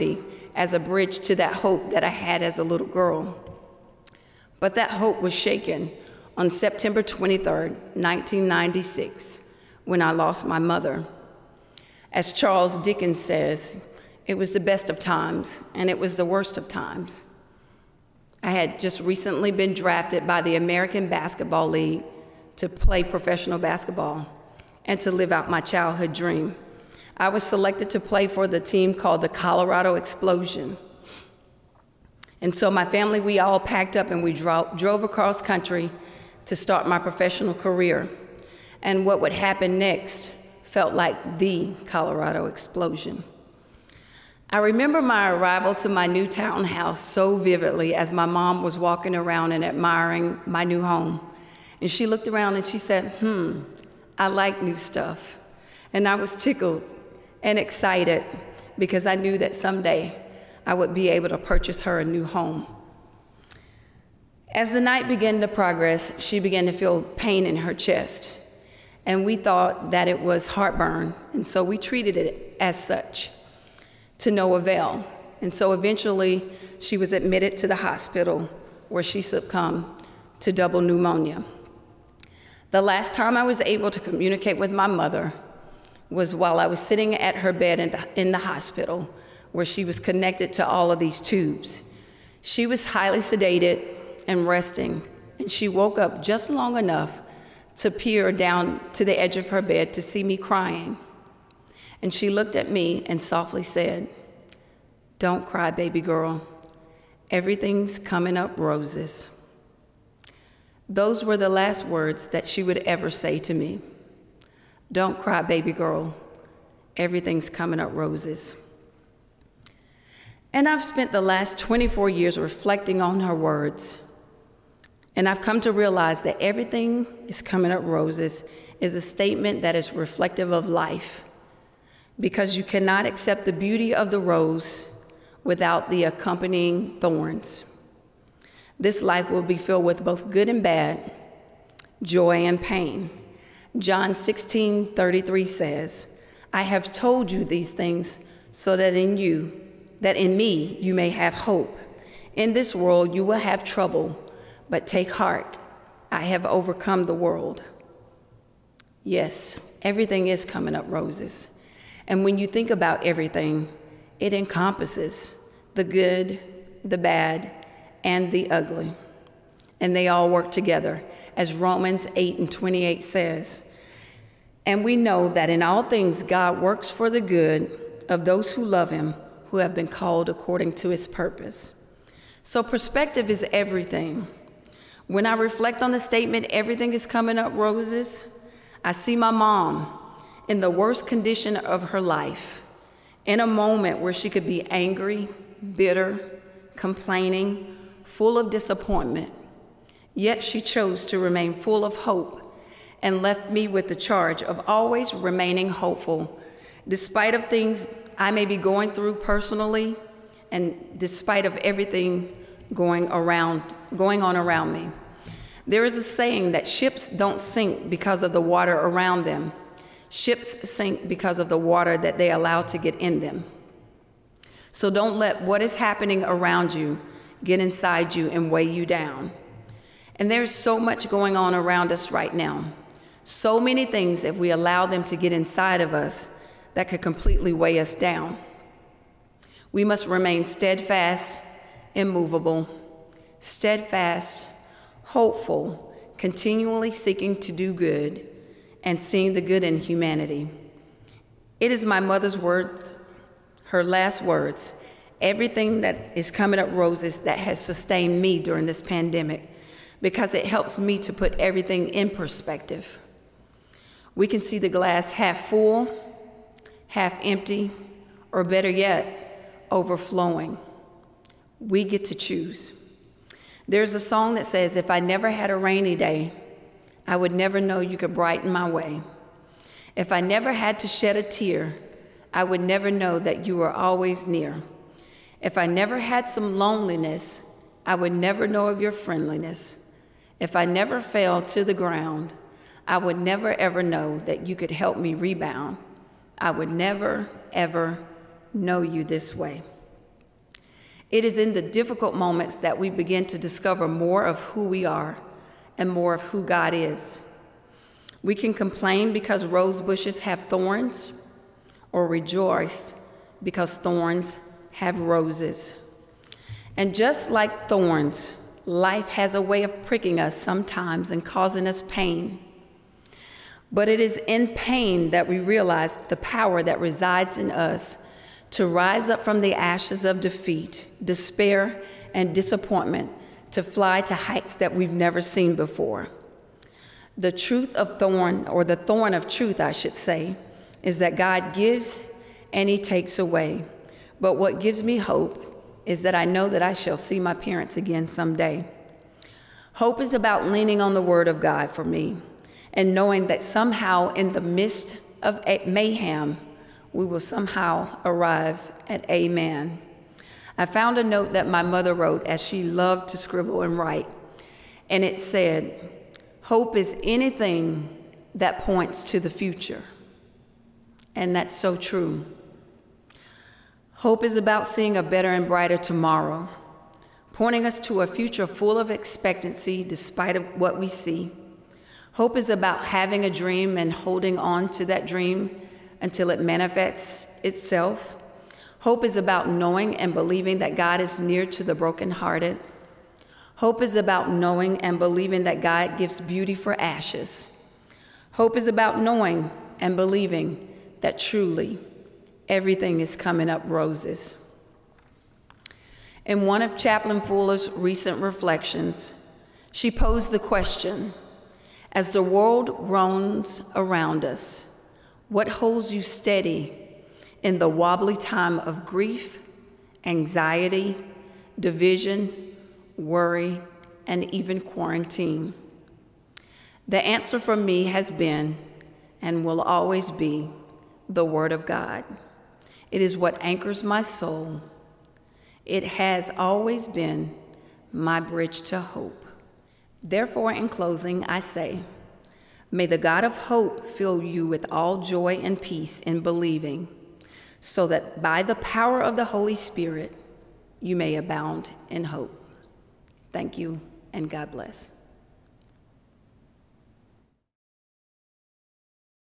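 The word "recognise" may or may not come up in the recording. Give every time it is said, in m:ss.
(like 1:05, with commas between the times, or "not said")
not said.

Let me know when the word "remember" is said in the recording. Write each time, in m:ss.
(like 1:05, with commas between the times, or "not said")
0:44.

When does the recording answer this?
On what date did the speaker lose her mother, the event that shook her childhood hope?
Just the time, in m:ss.
0:06.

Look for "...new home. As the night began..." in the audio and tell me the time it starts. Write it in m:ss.
1:02.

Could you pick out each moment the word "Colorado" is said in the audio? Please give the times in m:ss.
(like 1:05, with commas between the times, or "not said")
0:29, 0:41.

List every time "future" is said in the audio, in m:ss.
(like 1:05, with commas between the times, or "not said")
6:09, 6:18.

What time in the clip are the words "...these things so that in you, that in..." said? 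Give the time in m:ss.
2:27.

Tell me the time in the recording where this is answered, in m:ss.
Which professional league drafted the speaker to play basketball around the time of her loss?
0:20.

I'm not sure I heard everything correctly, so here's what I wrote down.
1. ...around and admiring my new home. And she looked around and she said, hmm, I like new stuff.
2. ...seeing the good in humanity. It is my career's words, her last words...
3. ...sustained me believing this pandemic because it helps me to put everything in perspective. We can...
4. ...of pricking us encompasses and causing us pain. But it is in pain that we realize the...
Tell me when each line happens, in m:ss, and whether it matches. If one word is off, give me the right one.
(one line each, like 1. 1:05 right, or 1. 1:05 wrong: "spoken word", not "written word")
1. 0:49 right
2. 4:08 wrong: "mother", not "career"
3. 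4:17 wrong: "during", not "believing"
4. 5:19 wrong: "sometimes", not "encompasses".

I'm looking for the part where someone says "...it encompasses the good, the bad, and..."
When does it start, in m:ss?
2:44.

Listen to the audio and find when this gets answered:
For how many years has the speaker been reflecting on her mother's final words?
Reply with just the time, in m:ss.
2:01.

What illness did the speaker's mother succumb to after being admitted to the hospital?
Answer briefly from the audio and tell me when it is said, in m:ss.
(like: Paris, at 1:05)
Double pneumonia, at 1:20.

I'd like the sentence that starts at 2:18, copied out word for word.
This life will be filled with both good and bad, joy and pain.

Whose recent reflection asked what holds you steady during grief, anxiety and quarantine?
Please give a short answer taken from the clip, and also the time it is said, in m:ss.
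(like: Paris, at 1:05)
Chaplain Fuller, at 6:46.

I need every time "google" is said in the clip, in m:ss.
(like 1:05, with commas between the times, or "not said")
not said.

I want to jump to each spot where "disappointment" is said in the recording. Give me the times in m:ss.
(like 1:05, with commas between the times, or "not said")
3:18, 5:32.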